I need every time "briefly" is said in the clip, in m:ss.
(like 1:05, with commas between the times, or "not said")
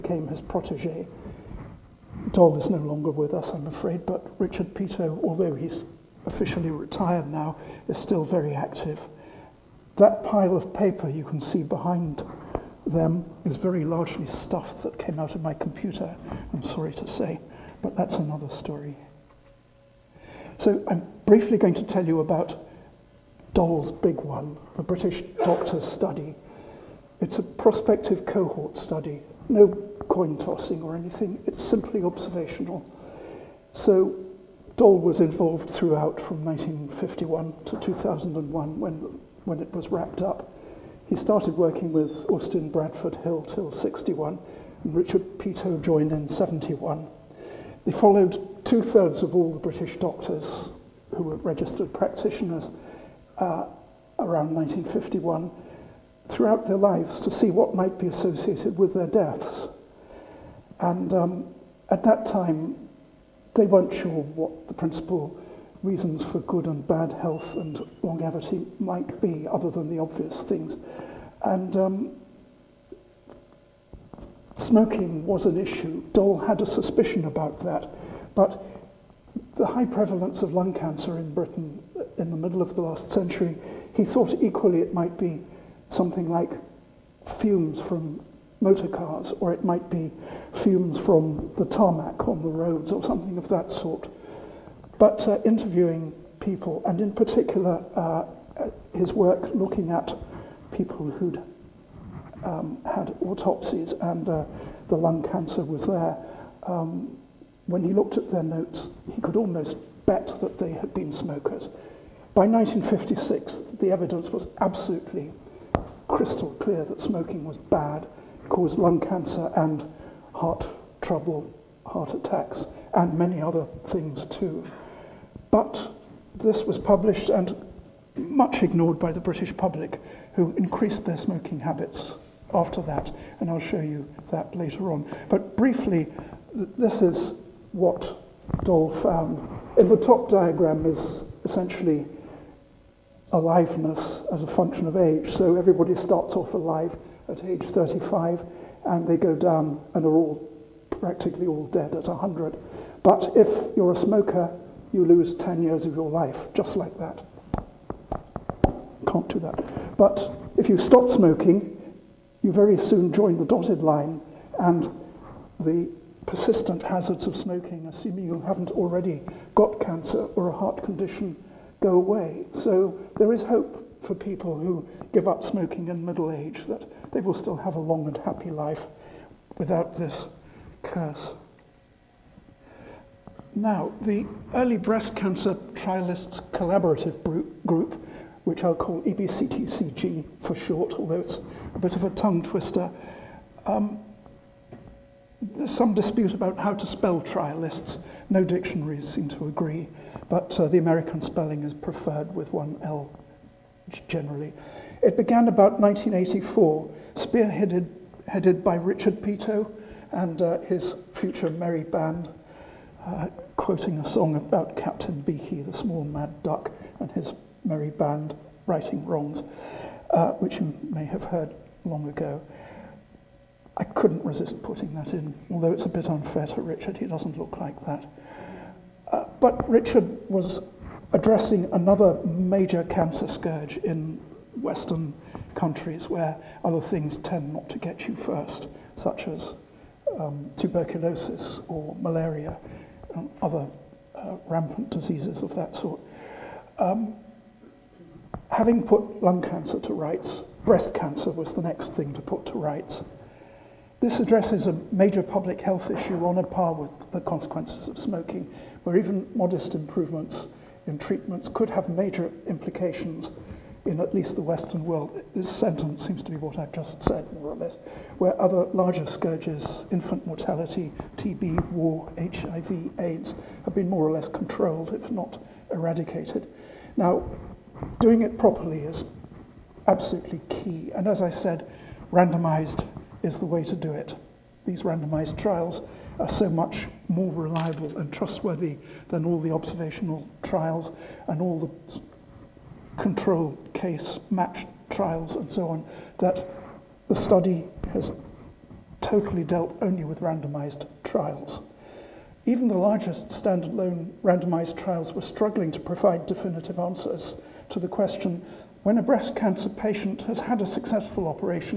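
0:21, 2:15.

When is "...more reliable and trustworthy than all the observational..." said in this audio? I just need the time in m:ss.
4:47.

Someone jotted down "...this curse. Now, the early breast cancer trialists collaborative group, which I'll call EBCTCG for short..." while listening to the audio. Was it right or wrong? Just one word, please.
right.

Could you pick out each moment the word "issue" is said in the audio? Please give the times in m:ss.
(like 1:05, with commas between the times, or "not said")
1:15, 4:15.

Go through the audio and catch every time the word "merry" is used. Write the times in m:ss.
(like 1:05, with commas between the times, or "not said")
3:31, 3:37.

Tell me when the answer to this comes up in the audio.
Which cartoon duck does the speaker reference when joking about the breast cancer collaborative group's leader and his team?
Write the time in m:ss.
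3:34.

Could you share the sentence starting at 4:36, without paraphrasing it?
Now, doing it properly is absolutely key.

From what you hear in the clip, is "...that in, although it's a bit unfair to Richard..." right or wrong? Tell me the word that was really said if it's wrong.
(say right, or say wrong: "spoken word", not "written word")
right.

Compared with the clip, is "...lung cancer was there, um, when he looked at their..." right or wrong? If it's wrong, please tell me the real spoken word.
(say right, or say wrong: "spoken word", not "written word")
right.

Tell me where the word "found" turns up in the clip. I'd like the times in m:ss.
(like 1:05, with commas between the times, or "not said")
2:18.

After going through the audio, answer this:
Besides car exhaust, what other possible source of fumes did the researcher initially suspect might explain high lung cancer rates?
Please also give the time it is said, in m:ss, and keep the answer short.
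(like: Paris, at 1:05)
tarmac on the roads, at 1:31.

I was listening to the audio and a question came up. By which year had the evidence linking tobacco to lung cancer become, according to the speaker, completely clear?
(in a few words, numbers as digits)
1956.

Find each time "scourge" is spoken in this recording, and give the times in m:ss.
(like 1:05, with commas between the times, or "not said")
3:53, 4:29.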